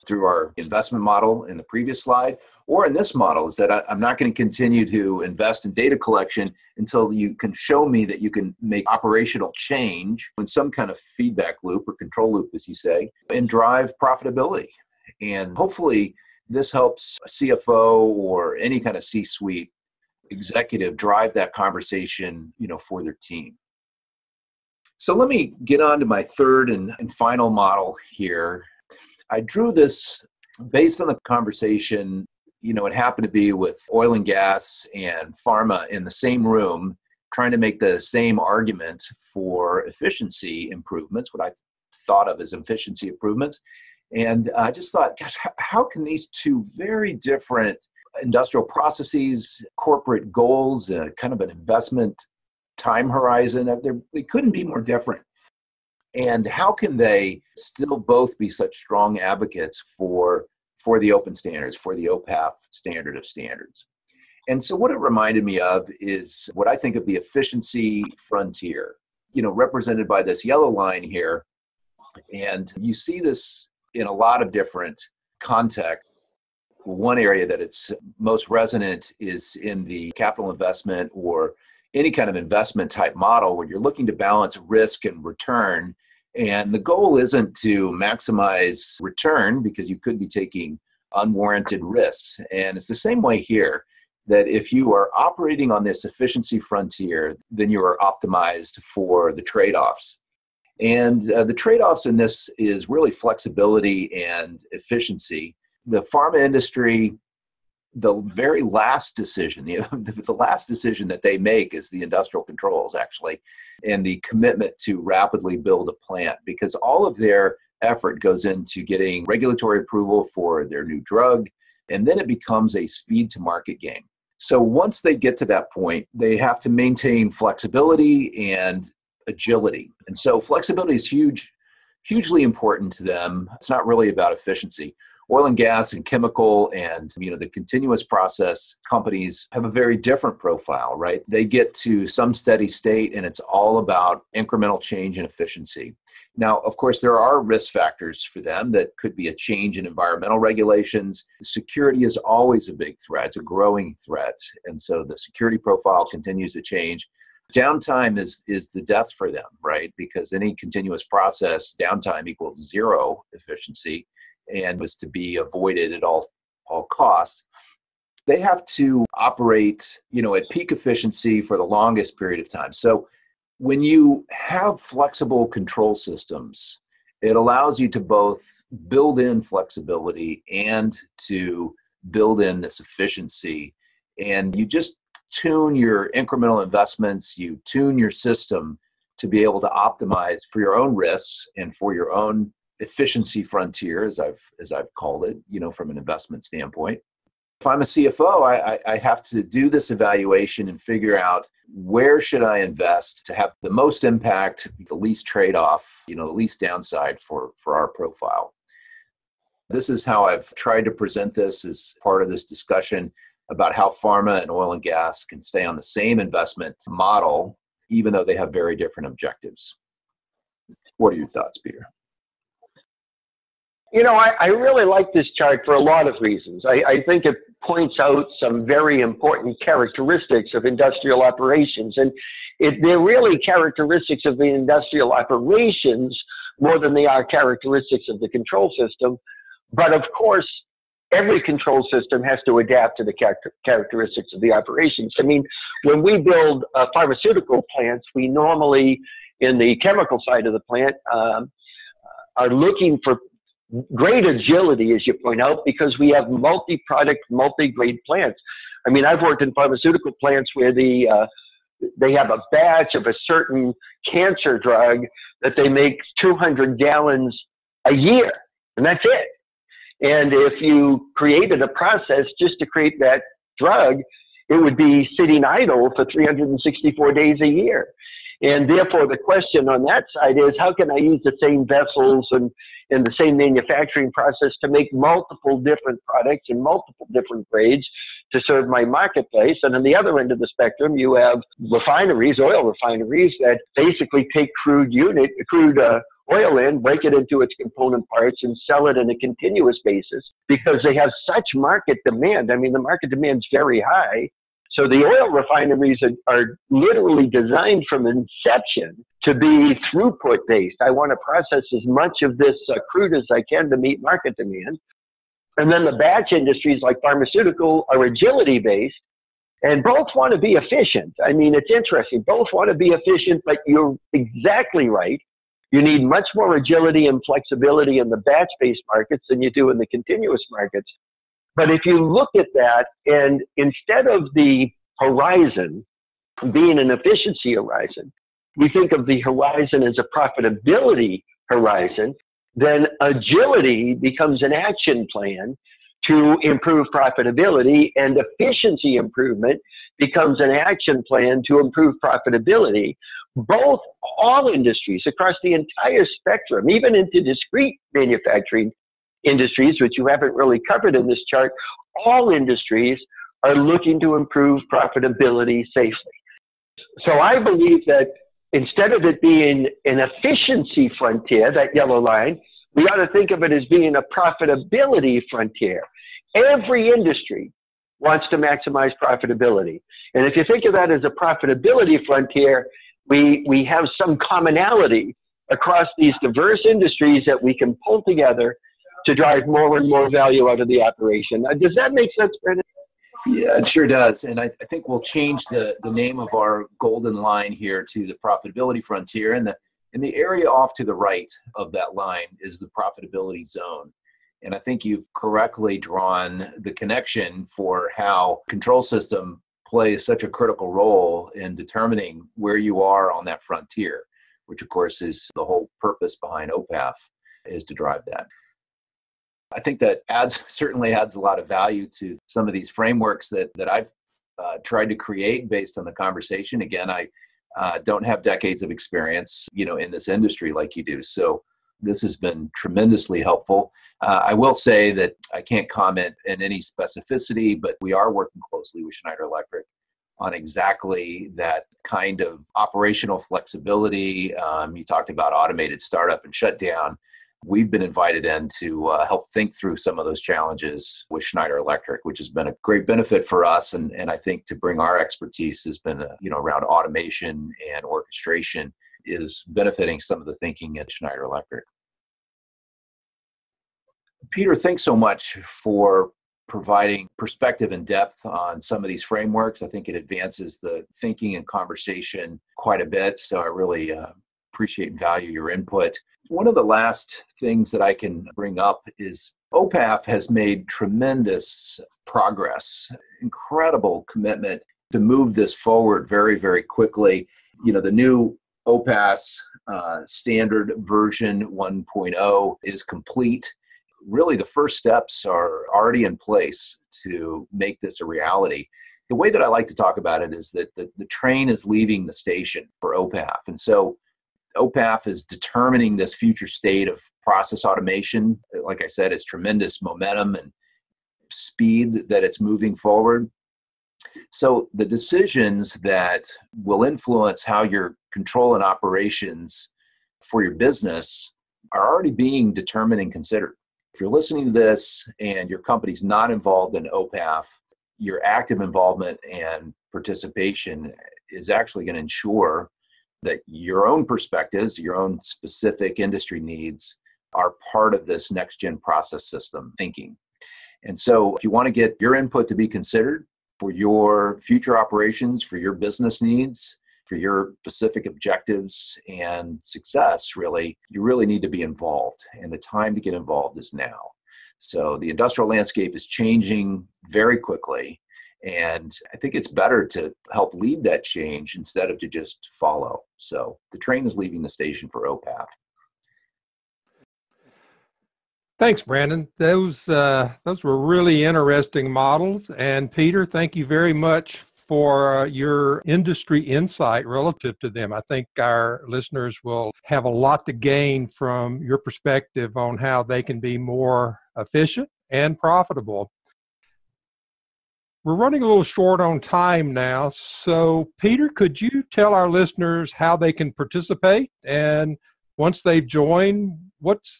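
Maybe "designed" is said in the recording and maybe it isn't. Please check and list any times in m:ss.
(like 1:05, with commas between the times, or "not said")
5:07.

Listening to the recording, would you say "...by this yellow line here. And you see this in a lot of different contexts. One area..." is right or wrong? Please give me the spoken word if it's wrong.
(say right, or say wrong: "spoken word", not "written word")
right.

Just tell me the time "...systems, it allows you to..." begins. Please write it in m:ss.
2:55.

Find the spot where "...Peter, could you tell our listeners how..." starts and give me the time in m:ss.
9:50.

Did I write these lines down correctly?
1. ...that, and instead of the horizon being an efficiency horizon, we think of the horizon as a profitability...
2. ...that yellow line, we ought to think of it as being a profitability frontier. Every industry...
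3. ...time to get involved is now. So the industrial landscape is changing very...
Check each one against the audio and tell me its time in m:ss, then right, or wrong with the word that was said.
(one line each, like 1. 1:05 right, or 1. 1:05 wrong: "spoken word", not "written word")
1. 5:32 right
2. 6:11 right
3. 9:12 right.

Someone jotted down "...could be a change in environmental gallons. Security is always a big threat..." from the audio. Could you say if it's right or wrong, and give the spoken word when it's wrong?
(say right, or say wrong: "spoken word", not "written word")
wrong: "regulations", not "gallons".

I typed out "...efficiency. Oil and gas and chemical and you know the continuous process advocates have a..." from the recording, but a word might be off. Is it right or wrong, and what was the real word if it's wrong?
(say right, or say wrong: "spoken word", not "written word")
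wrong: "companies", not "advocates".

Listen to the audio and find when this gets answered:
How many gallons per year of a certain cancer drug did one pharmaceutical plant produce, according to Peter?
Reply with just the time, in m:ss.
4:26.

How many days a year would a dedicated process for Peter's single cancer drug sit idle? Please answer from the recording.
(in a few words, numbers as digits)
364.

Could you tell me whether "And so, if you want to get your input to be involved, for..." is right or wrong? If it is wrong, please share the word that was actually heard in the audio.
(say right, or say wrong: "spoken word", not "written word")
wrong: "considered", not "involved".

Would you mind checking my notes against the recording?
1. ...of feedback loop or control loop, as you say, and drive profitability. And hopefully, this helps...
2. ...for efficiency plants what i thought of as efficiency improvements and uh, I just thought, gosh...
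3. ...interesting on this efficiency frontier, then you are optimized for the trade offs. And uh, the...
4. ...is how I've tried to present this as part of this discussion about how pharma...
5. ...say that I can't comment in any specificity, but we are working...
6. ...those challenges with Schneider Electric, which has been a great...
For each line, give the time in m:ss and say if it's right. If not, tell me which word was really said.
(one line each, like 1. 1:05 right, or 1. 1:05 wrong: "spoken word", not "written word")
1. 0:10 right
2. 0:39 wrong: "improvements", not "plants"
3. 1:35 wrong: "operating", not "interesting"
4. 3:29 right
5. 7:14 right
6. 7:30 right.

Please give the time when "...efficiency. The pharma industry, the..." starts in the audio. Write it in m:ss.
1:44.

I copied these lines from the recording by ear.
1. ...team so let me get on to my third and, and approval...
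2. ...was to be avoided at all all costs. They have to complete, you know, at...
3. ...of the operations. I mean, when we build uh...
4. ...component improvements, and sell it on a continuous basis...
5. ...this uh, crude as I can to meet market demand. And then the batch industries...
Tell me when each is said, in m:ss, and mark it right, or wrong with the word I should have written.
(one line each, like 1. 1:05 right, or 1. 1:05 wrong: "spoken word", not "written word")
1. 0:23 wrong: "final", not "approval"
2. 2:44 wrong: "operate", not "complete"
3. 4:04 right
4. 4:57 wrong: "parts", not "improvements"
5. 5:12 right.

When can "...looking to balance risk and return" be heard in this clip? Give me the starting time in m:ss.
1:23.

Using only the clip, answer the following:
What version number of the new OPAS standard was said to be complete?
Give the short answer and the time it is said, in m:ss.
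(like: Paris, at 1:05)
1.0, at 8:10.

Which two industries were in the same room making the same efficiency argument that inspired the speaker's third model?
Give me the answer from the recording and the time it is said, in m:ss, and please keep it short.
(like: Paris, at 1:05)
oil and gas and pharma, at 0:33.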